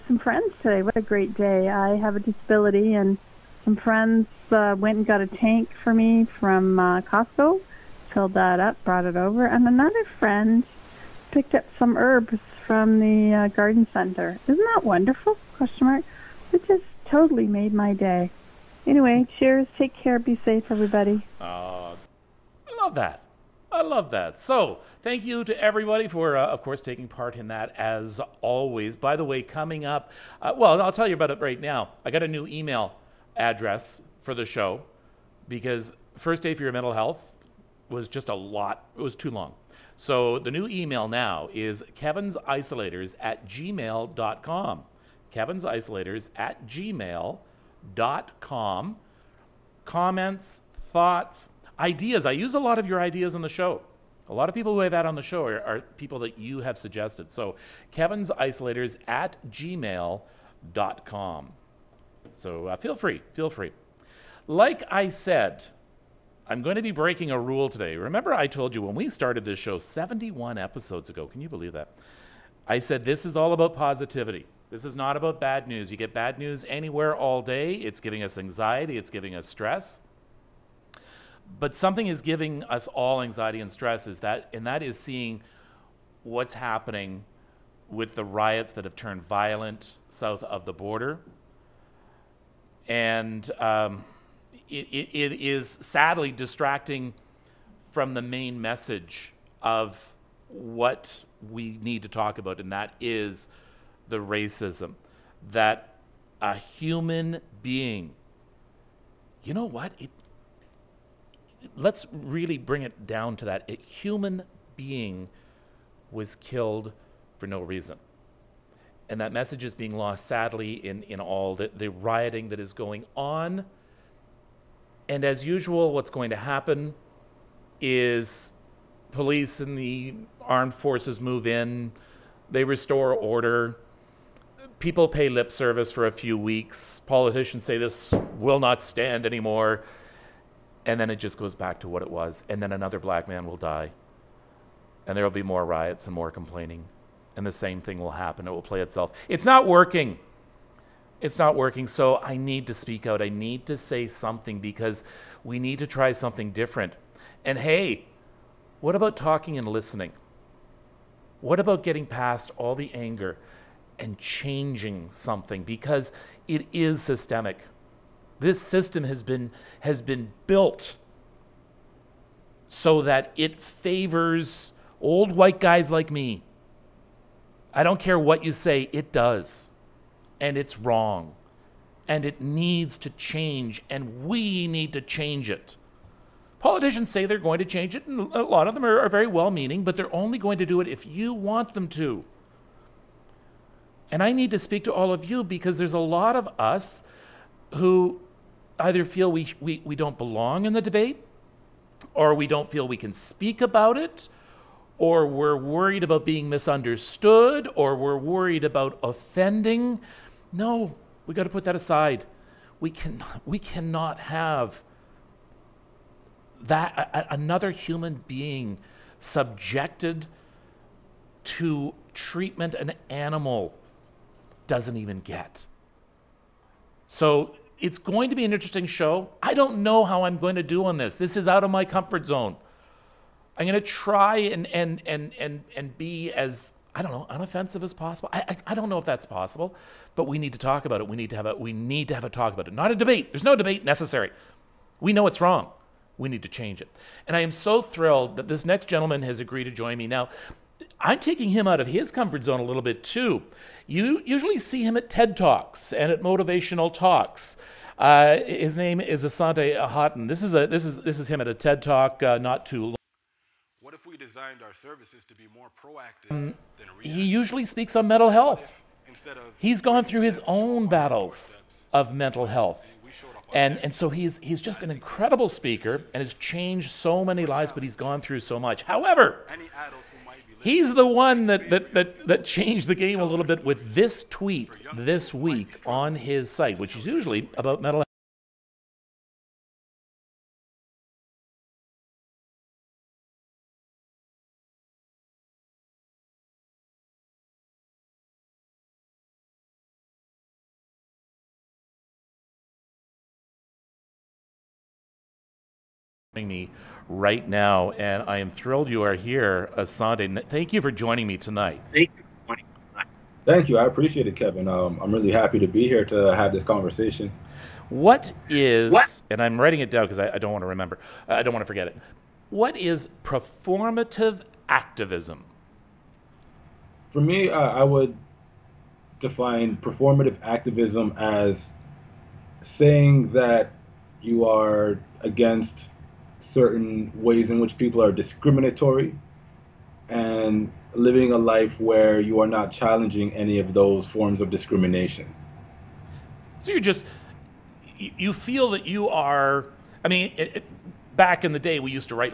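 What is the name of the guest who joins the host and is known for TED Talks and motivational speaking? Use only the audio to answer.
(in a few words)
Asante Haughton.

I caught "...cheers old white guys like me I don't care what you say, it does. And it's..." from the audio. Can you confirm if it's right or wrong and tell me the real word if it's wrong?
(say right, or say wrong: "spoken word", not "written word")
wrong: "favors", not "cheers".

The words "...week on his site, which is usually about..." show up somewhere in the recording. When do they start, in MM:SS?
04:45.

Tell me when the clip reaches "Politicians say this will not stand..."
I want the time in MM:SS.
02:17.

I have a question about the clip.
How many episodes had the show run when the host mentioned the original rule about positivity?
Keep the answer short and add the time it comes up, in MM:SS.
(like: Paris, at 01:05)
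71, at 01:09.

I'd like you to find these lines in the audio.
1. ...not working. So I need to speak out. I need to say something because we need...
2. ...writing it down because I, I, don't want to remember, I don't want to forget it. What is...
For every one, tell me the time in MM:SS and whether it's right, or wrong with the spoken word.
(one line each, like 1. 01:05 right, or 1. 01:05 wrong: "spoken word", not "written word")
1. 02:31 right
2. 05:19 right.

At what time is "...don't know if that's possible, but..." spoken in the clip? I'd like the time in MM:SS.
03:58.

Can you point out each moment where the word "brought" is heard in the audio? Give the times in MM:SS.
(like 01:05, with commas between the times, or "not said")
00:08.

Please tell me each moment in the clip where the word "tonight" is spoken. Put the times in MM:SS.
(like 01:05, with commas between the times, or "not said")
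05:11.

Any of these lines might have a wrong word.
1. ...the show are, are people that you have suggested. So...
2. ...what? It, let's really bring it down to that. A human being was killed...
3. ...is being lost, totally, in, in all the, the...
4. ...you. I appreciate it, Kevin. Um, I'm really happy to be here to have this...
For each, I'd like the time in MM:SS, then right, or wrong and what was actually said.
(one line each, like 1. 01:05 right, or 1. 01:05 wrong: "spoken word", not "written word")
1. 00:55 right
2. 01:49 right
3. 01:59 wrong: "sadly", not "totally"
4. 05:13 right.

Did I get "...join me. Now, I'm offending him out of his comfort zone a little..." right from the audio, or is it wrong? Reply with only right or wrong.
wrong.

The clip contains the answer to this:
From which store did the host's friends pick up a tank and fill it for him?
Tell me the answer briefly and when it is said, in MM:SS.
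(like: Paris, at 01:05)
Costco, at 00:07.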